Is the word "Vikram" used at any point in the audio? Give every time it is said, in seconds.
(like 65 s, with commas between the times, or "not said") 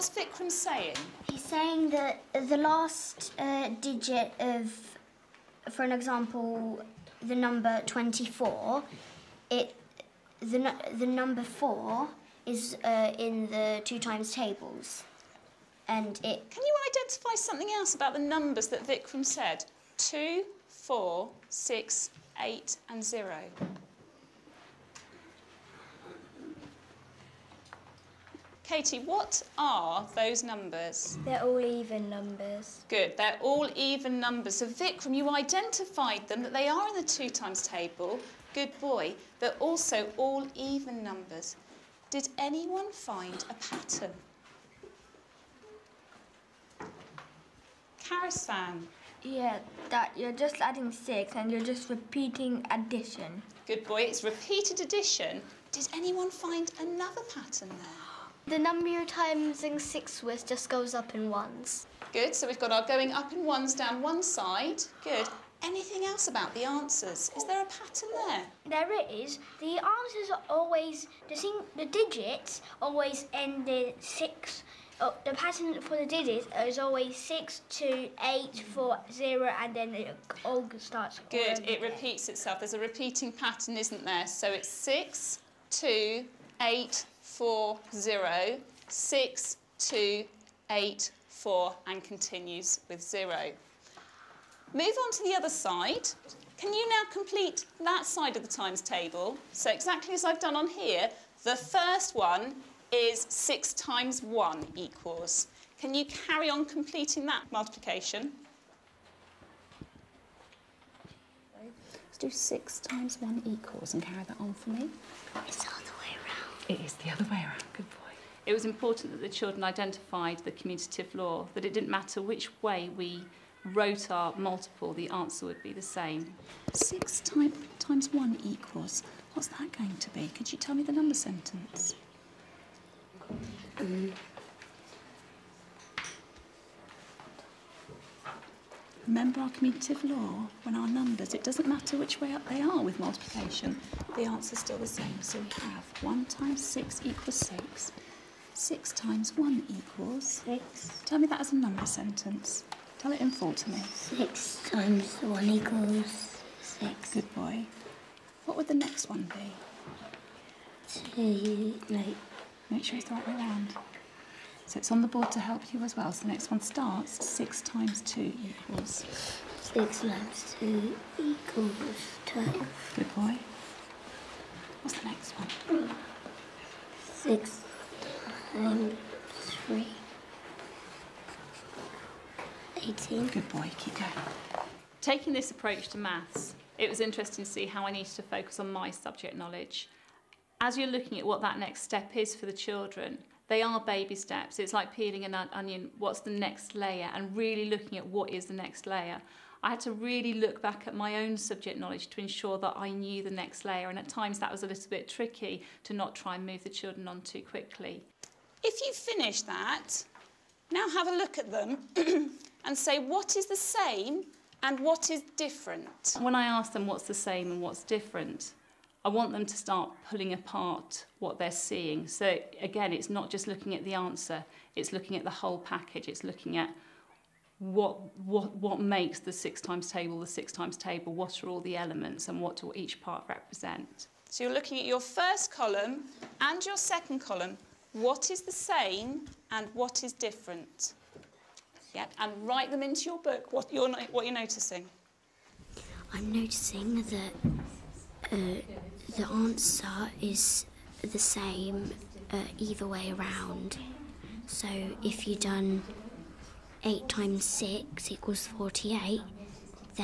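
0 s, 18 s, 34 s.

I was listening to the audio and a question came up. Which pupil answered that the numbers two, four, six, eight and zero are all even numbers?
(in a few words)
Katie.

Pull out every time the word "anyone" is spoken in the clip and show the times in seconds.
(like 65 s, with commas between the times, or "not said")
42 s, 55 s.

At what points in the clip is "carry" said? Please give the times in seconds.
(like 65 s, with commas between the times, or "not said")
106 s, 114 s.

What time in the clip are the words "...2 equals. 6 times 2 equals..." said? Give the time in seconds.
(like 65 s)
168 s.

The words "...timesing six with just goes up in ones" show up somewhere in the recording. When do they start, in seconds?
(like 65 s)
59 s.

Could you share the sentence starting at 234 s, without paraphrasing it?
So you're looking at your first column and your second column.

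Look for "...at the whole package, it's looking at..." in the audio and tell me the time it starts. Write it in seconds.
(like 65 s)
225 s.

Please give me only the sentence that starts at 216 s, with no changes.
When I ask them what's the same and what's different, I want them to start pulling apart what they're seeing.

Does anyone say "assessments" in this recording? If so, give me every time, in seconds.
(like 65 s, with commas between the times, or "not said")
not said.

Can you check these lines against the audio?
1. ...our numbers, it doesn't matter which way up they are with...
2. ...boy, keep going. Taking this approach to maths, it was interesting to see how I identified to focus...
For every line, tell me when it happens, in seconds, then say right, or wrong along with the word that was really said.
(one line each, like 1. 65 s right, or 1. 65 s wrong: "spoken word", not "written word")
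1. 140 s right
2. 183 s wrong: "needed", not "identified".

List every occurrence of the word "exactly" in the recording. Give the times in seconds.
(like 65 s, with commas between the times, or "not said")
99 s.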